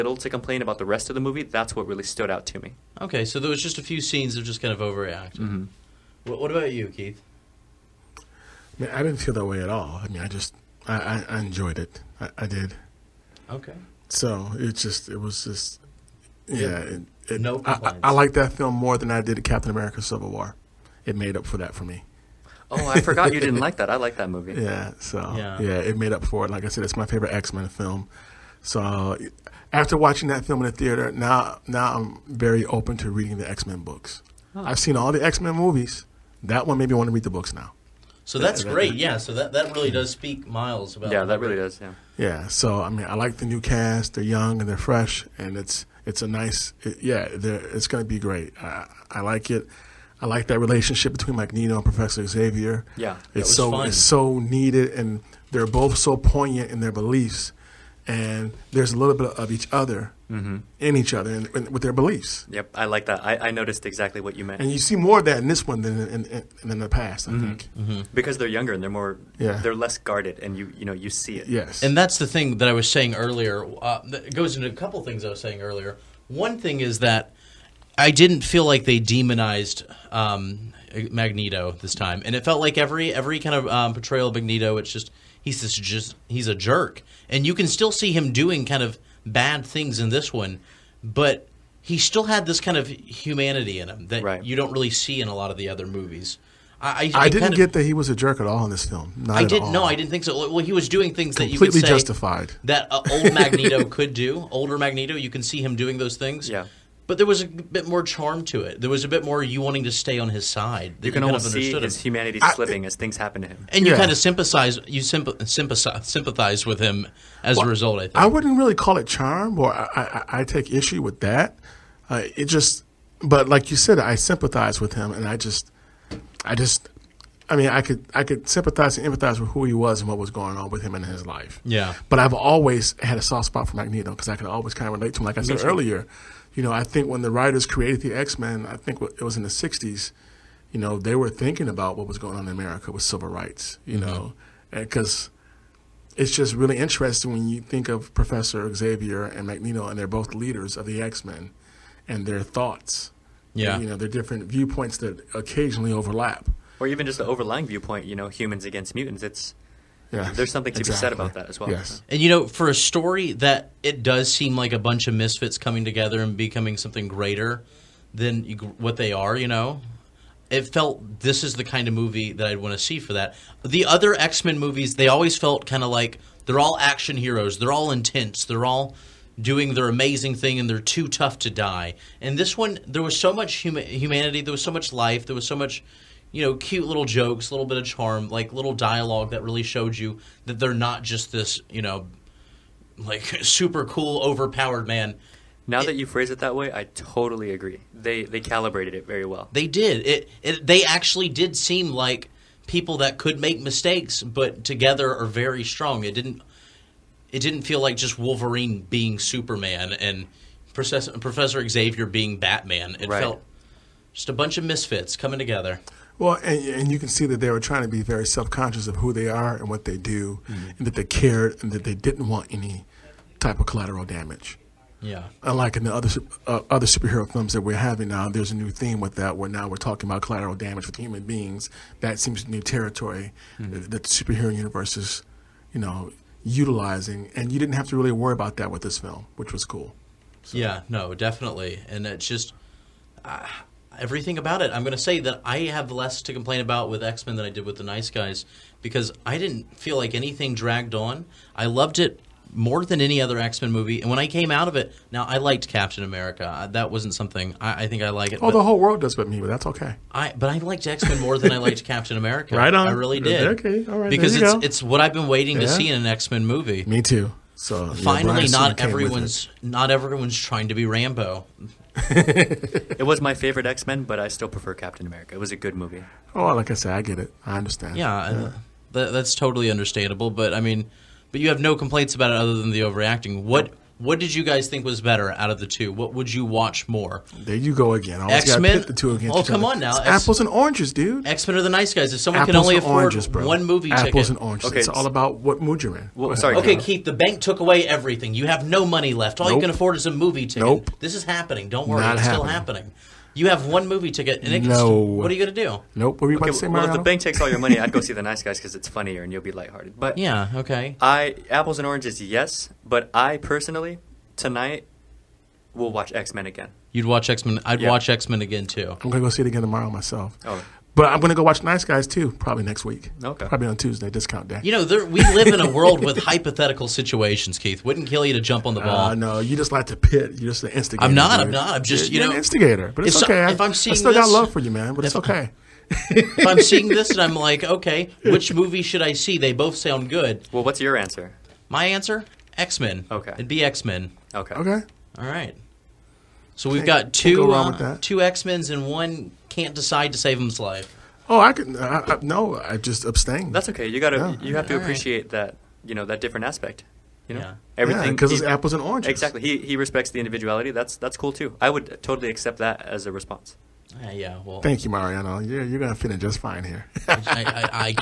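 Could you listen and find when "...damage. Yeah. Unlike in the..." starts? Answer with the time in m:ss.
3:44.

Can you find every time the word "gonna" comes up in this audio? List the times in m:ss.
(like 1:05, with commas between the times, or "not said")
5:19, 6:05.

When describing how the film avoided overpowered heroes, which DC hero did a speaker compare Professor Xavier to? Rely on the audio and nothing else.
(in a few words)
Batman.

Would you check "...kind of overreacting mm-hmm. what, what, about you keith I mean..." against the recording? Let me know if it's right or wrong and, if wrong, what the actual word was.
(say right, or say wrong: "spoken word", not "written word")
right.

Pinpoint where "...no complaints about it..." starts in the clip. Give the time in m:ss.
4:41.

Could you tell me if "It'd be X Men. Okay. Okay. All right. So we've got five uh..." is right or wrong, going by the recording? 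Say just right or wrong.
wrong.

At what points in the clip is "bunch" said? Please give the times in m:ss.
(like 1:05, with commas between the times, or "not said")
2:44, 3:34.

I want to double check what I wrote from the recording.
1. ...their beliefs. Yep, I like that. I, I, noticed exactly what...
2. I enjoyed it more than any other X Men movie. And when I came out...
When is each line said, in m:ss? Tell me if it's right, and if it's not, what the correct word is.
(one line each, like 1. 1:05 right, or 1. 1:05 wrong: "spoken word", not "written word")
1. 1:01 right
2. 4:11 wrong: "loved", not "enjoyed".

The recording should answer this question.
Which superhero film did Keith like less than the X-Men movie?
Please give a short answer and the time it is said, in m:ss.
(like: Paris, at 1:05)
Captain America: Civil War, at 0:19.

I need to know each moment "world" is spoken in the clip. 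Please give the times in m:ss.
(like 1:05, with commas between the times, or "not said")
4:18, 5:25.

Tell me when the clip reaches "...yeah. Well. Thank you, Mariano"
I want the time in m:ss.
6:04.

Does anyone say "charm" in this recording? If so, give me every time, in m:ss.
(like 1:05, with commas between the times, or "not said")
1:48, 1:59, 3:07.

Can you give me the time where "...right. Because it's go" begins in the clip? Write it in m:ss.
4:23.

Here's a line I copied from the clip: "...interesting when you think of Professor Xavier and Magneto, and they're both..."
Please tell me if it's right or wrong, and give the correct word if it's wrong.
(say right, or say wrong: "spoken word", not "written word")
right.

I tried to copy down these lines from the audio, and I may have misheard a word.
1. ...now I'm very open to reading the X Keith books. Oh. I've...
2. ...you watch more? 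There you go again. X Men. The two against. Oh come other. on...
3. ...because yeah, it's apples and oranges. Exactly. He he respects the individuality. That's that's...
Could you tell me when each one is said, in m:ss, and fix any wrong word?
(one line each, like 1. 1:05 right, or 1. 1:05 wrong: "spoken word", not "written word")
1. 0:31 wrong: "Men", not "Keith"
2. 4:46 right
3. 5:58 right.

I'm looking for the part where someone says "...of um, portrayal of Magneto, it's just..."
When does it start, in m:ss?
1:23.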